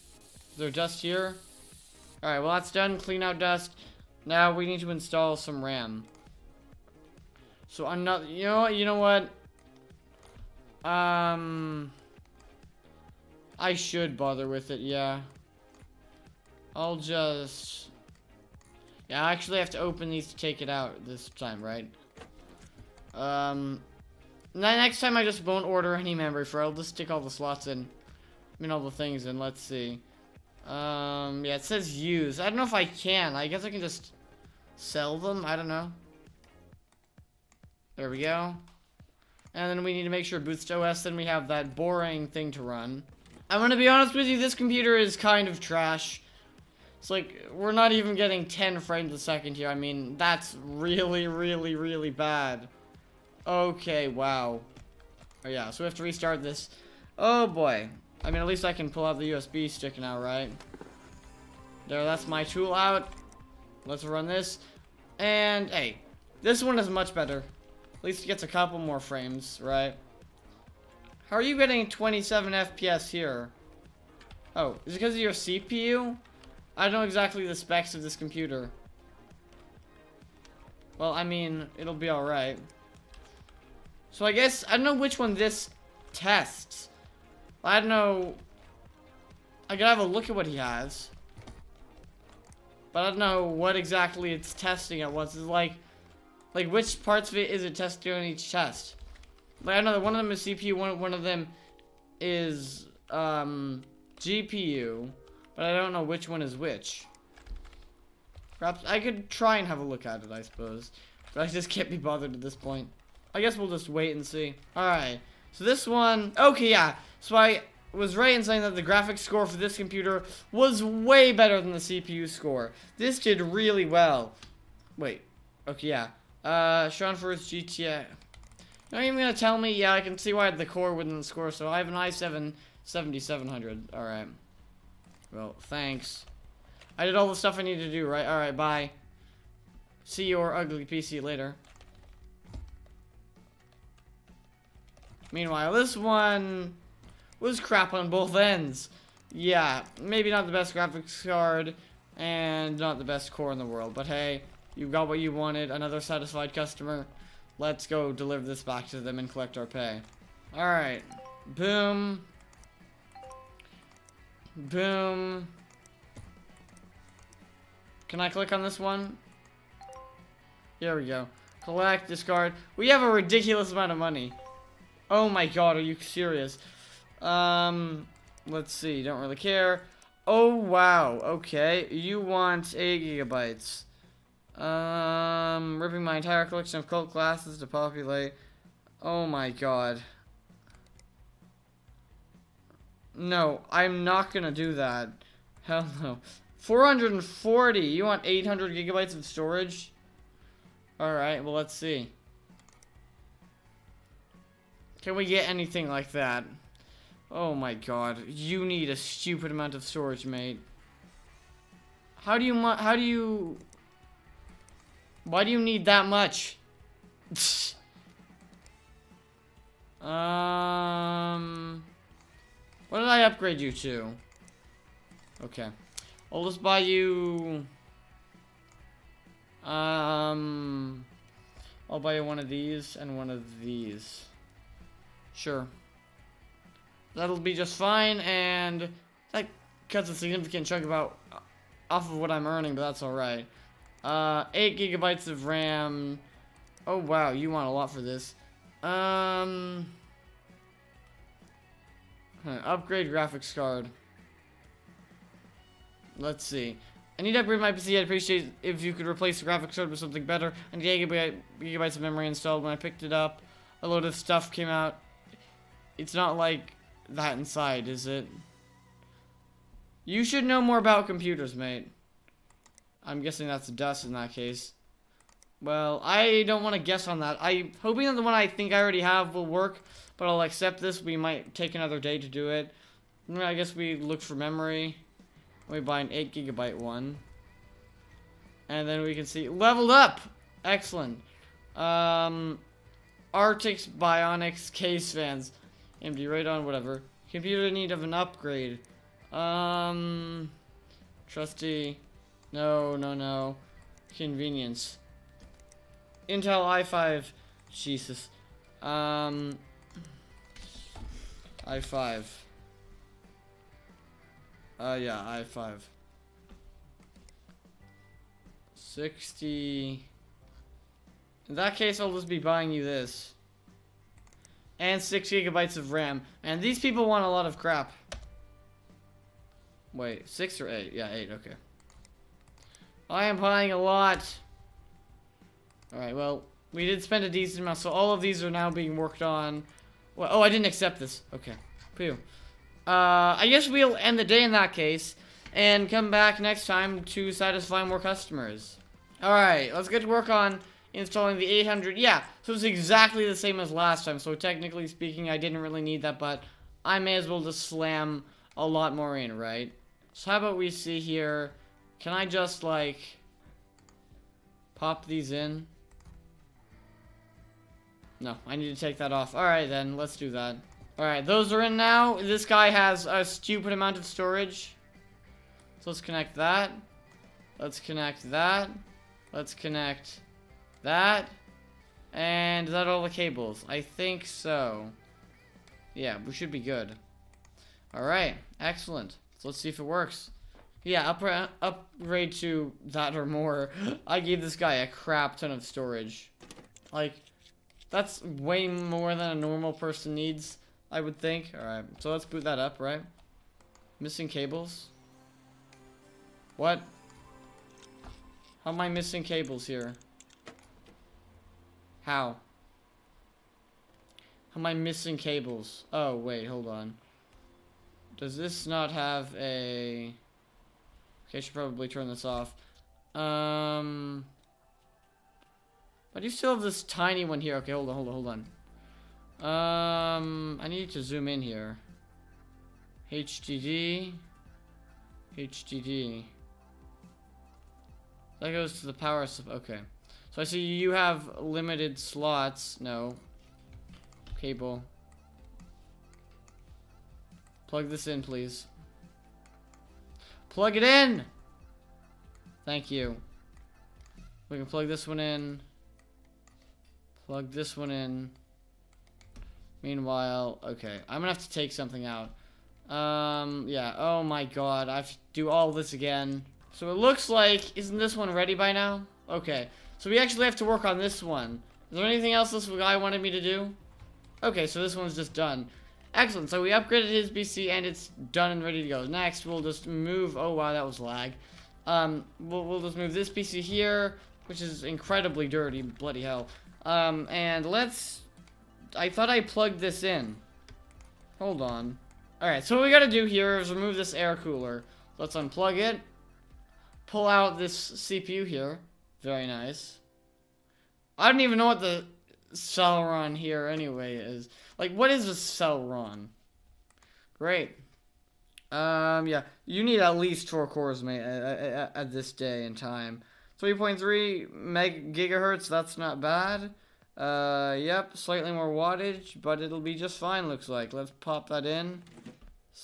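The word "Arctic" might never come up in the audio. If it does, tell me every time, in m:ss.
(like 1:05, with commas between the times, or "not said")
4:53.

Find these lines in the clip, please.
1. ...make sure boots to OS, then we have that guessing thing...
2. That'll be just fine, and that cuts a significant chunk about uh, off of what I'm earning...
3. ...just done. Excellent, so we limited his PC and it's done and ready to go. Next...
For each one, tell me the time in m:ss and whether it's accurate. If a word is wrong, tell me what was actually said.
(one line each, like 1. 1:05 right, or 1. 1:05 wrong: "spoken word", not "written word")
1. 0:40 wrong: "boring", not "guessing"
2. 3:57 right
3. 7:55 wrong: "upgraded", not "limited".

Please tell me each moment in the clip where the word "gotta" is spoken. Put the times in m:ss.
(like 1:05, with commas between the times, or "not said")
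1:29, 8:12.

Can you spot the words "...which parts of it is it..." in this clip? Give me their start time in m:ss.
1:36.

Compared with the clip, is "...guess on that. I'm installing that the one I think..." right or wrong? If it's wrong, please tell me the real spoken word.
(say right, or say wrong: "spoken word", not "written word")
wrong: "hoping", not "installing".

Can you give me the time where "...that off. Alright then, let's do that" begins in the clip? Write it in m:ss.
6:08.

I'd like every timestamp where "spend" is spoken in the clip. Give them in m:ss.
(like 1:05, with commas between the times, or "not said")
5:37.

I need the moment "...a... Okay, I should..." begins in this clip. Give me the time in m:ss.
6:59.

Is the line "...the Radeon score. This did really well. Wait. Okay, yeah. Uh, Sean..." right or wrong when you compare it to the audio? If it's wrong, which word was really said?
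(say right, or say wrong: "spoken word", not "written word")
wrong: "CPU", not "Radeon".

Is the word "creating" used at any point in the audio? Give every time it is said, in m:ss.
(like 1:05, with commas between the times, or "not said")
not said.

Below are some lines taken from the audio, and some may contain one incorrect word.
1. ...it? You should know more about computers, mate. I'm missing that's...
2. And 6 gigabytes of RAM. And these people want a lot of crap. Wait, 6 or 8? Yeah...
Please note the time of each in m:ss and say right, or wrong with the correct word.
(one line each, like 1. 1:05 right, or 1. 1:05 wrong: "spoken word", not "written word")
1. 4:28 wrong: "guessing", not "missing"
2. 5:24 right.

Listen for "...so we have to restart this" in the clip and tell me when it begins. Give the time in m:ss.
0:55.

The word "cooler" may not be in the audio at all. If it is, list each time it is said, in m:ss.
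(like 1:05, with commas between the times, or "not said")
8:14.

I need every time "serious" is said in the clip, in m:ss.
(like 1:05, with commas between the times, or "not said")
2:55.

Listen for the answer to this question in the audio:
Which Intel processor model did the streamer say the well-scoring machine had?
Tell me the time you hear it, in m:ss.
2:11.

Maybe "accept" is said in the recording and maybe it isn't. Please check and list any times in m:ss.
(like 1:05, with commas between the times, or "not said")
4:40, 5:40.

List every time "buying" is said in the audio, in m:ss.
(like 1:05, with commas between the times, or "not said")
5:22, 5:33.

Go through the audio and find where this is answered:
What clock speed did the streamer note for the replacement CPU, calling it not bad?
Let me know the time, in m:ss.
8:33.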